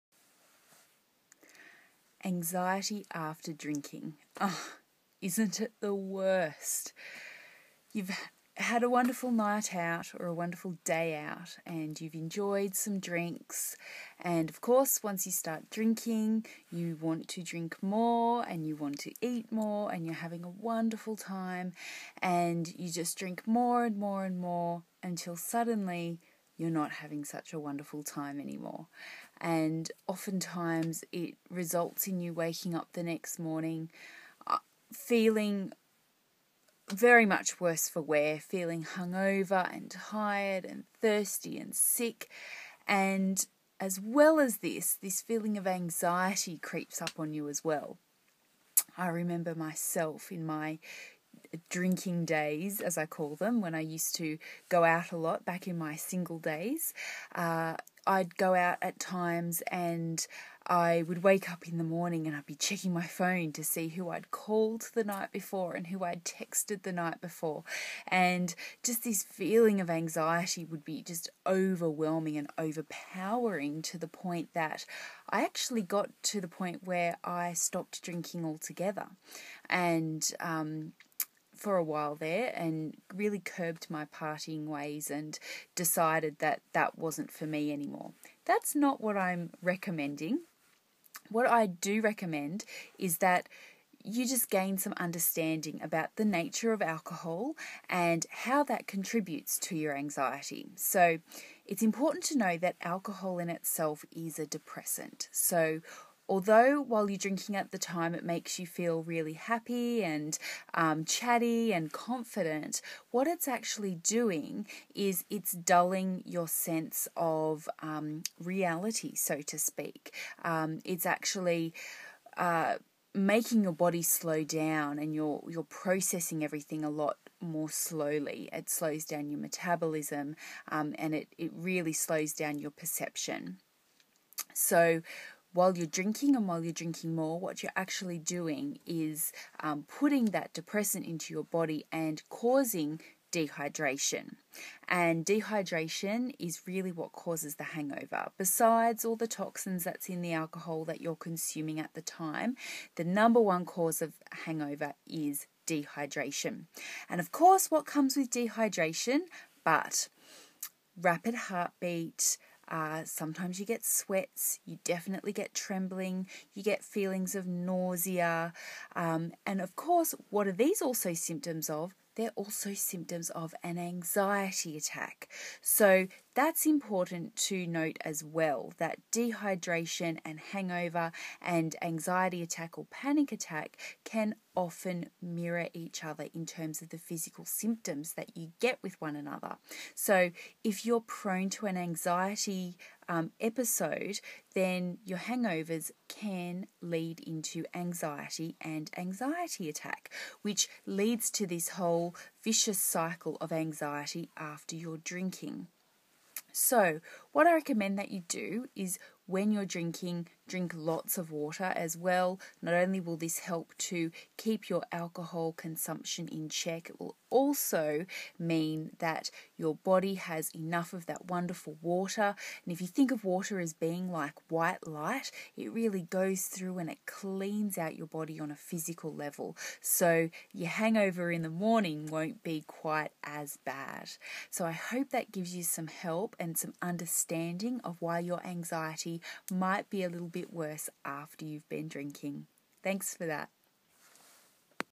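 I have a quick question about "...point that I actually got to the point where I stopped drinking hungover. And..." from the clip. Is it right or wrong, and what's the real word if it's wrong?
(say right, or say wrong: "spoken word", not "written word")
wrong: "altogether", not "hungover".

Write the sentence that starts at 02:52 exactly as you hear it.
They're also symptoms of an anxiety attack.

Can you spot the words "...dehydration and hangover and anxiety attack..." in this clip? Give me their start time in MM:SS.
02:59.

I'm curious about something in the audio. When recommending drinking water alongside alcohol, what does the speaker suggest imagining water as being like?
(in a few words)
white light.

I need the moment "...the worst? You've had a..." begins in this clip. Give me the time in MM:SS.
00:05.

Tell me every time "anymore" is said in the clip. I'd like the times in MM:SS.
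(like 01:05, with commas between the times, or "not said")
00:28, 01:27.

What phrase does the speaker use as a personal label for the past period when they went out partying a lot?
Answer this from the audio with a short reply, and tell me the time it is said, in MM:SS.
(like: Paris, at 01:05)
drinking days, at 00:51.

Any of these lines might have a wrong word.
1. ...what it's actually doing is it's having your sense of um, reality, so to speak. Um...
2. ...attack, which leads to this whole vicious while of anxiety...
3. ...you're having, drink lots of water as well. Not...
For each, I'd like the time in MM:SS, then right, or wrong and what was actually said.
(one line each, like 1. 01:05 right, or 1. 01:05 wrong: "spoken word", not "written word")
1. 01:53 wrong: "dulling", not "having"
2. 03:19 wrong: "cycle", not "while"
3. 03:29 wrong: "drinking", not "having".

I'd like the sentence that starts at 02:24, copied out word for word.
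And dehydration is really what causes the hangover.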